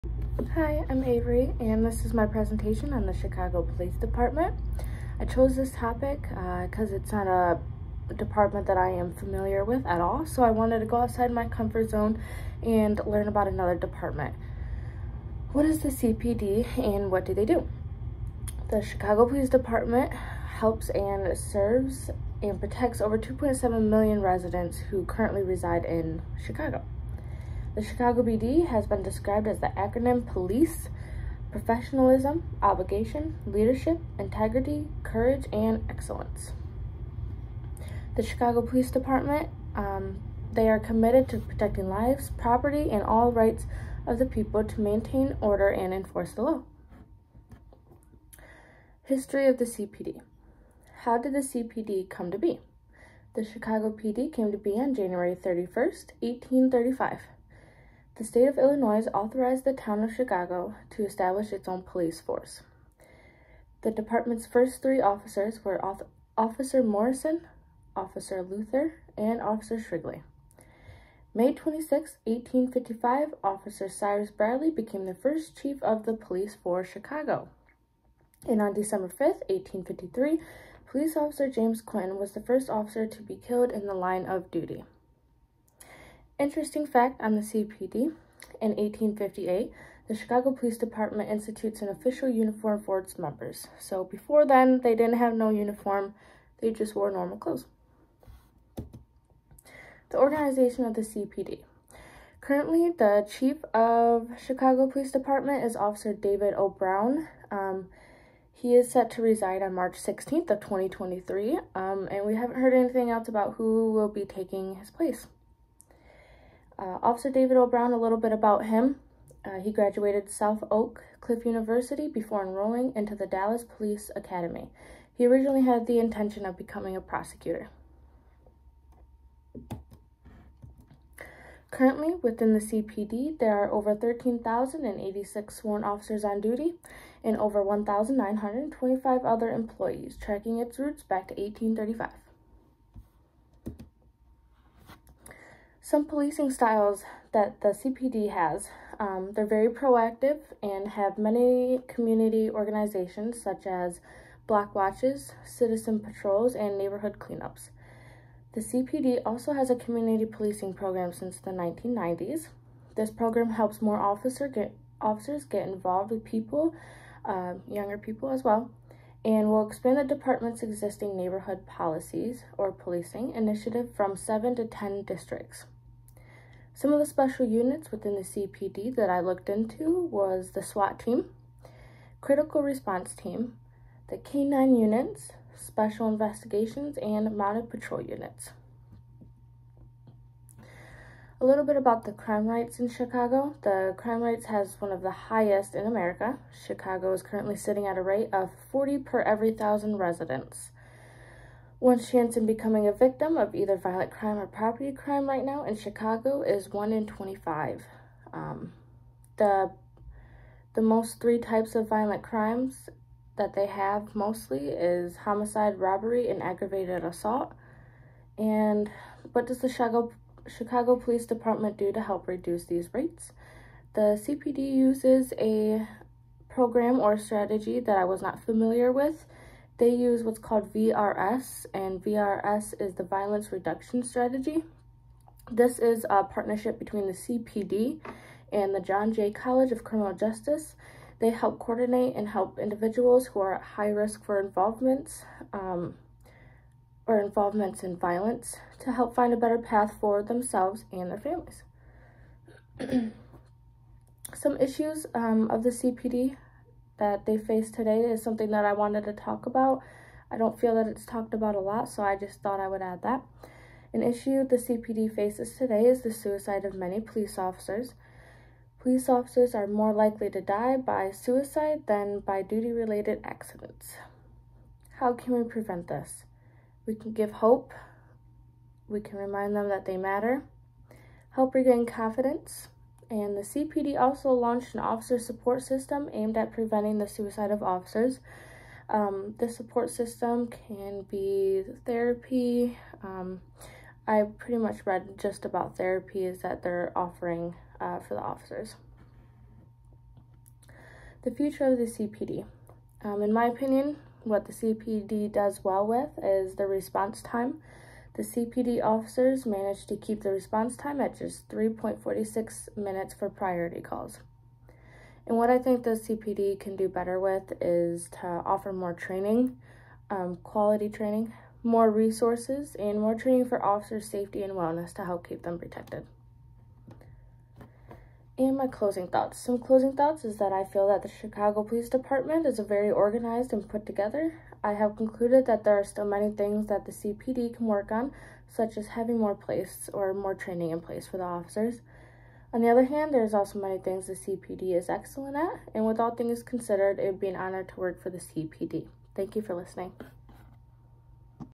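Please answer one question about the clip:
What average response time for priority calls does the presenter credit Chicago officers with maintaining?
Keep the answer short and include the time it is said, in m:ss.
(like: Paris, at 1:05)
3.46 minutes, at 5:11.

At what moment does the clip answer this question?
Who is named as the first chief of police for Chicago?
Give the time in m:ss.
1:13.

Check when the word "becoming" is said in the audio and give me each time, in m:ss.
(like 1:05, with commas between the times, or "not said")
2:06, 3:22.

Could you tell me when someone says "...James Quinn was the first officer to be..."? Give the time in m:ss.
1:21.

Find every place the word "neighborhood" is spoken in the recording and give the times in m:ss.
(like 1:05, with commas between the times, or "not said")
2:36, 2:51.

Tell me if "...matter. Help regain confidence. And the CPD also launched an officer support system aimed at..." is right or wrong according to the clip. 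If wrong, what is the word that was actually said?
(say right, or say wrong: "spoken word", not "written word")
right.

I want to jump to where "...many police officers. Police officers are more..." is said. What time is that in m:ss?
4:26.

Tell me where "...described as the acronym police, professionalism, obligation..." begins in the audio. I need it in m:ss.
0:29.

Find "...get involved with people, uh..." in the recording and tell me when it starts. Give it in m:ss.
2:45.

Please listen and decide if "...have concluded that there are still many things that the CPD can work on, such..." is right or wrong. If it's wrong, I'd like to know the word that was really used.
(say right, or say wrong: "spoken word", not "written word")
right.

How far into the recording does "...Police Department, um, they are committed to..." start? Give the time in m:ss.
0:38.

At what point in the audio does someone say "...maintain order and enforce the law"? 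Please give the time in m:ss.
0:44.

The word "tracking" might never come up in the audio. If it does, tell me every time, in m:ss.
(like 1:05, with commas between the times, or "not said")
2:20.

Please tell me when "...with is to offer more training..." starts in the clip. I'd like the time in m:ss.
5:17.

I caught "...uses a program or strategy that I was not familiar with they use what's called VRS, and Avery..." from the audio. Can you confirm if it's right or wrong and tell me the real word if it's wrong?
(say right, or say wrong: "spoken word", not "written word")
wrong: "VRS", not "Avery".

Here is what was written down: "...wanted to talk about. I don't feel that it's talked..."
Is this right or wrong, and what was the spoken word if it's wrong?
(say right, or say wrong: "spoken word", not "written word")
right.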